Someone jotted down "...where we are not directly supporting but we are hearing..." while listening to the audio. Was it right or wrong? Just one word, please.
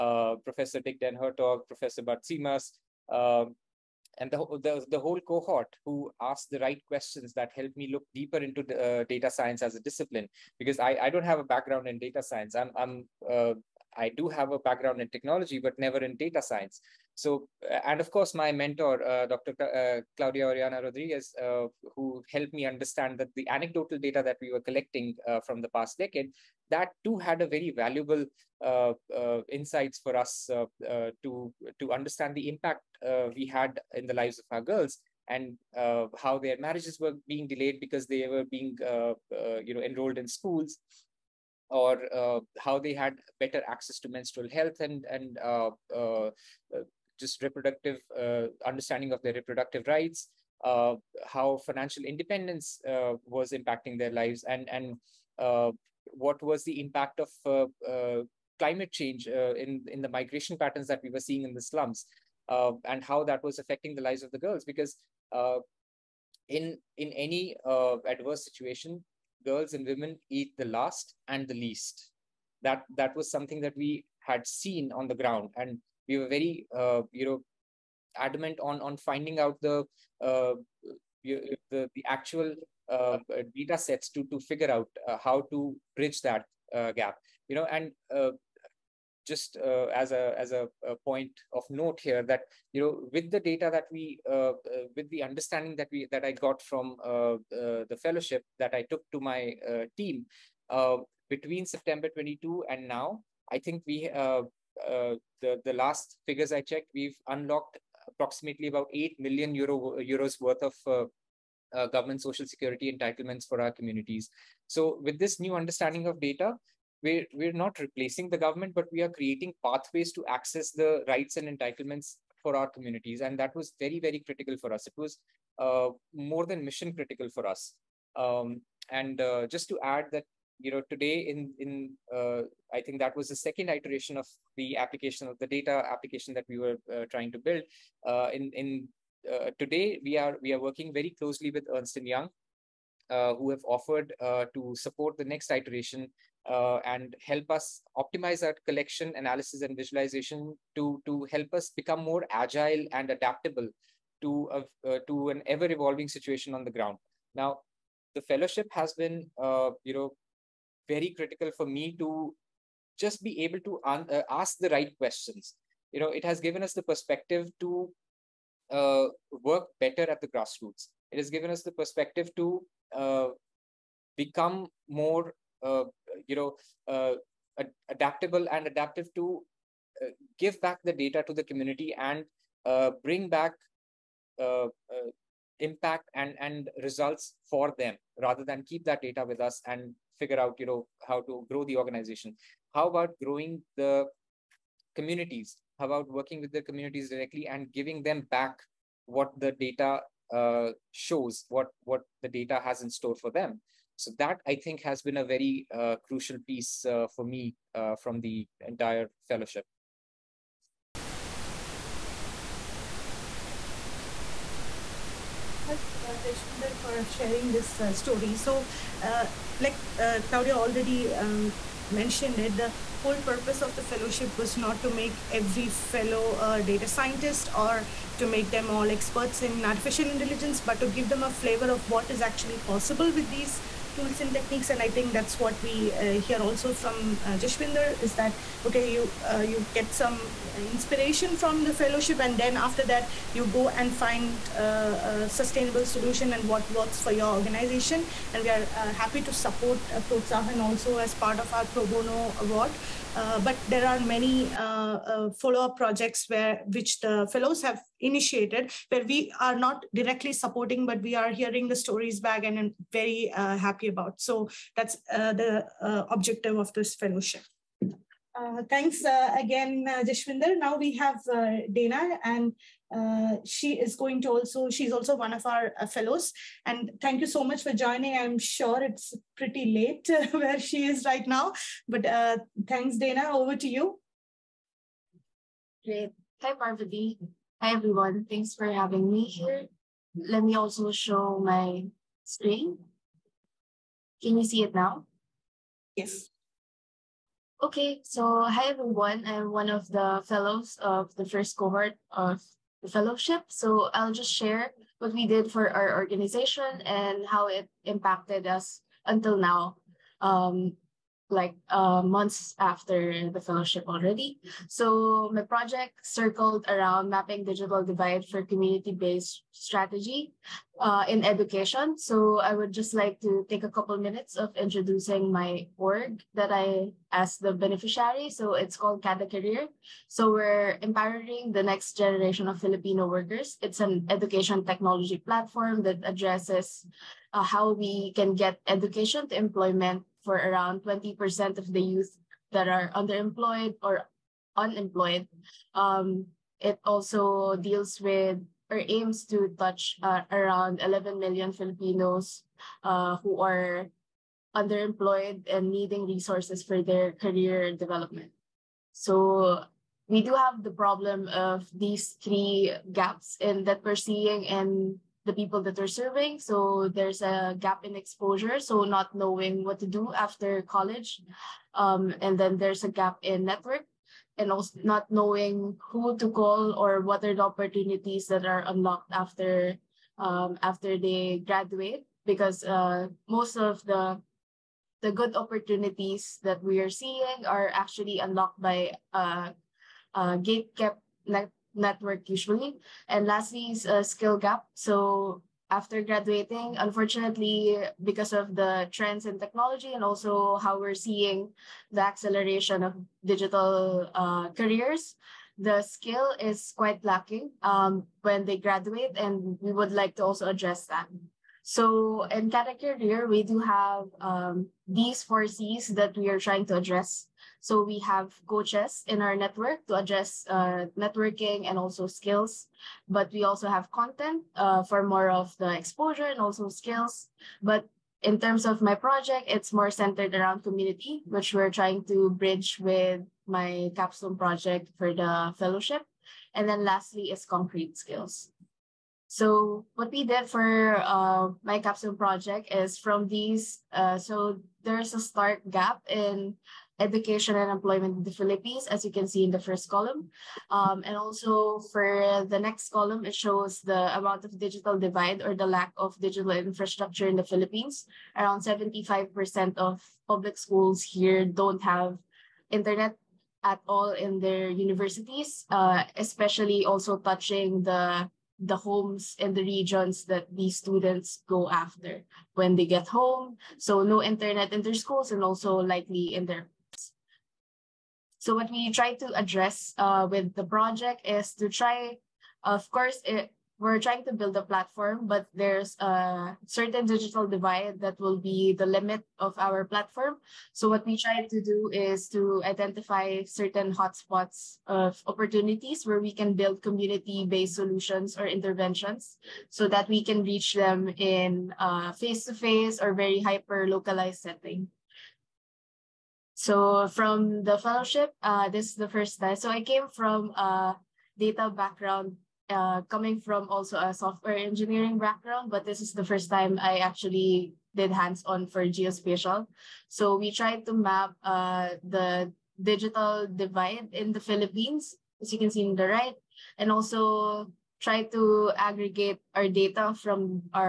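right.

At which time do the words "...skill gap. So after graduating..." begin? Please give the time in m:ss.
6:34.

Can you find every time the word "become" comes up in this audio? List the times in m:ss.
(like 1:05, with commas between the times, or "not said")
2:31, 2:54.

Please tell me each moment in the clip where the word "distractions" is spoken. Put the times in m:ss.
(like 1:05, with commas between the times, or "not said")
not said.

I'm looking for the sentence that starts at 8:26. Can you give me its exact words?
So from the fellowship, uh, this is the first time.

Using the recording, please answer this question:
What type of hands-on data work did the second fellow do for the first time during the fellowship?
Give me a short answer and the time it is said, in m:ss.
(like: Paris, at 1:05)
Geospatial, at 8:38.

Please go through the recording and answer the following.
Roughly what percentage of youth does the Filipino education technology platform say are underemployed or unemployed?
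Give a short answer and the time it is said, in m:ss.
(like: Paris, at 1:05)
20%, at 5:40.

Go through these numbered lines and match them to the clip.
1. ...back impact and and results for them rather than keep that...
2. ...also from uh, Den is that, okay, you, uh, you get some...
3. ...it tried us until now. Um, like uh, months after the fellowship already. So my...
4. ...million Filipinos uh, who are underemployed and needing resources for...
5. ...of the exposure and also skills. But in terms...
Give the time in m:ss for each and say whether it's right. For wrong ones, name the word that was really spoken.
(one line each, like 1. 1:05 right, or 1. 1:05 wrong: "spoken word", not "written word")
1. 3:03 right
2. 3:56 wrong: "Jashwinder", not "Den"
3. 5:07 wrong: "impacted", not "tried"
4. 5:51 right
5. 7:05 right.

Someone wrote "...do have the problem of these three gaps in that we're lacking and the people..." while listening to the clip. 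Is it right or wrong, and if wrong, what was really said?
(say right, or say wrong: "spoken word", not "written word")
wrong: "seeing", not "lacking".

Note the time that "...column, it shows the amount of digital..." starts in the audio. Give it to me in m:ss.
7:32.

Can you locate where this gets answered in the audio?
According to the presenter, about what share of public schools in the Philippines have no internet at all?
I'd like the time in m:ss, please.
7:38.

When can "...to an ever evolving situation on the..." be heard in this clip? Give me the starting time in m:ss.
2:35.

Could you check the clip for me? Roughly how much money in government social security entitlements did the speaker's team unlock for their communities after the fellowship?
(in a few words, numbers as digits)
8 million euros.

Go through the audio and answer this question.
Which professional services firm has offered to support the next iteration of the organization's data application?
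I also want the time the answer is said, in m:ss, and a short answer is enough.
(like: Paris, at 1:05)
Ernst and Young, at 2:21.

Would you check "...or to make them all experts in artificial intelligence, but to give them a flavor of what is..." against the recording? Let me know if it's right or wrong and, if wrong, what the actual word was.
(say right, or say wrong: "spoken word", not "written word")
right.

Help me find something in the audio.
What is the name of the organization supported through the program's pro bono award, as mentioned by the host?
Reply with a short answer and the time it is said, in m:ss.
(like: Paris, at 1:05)
Protsahan, at 4:09.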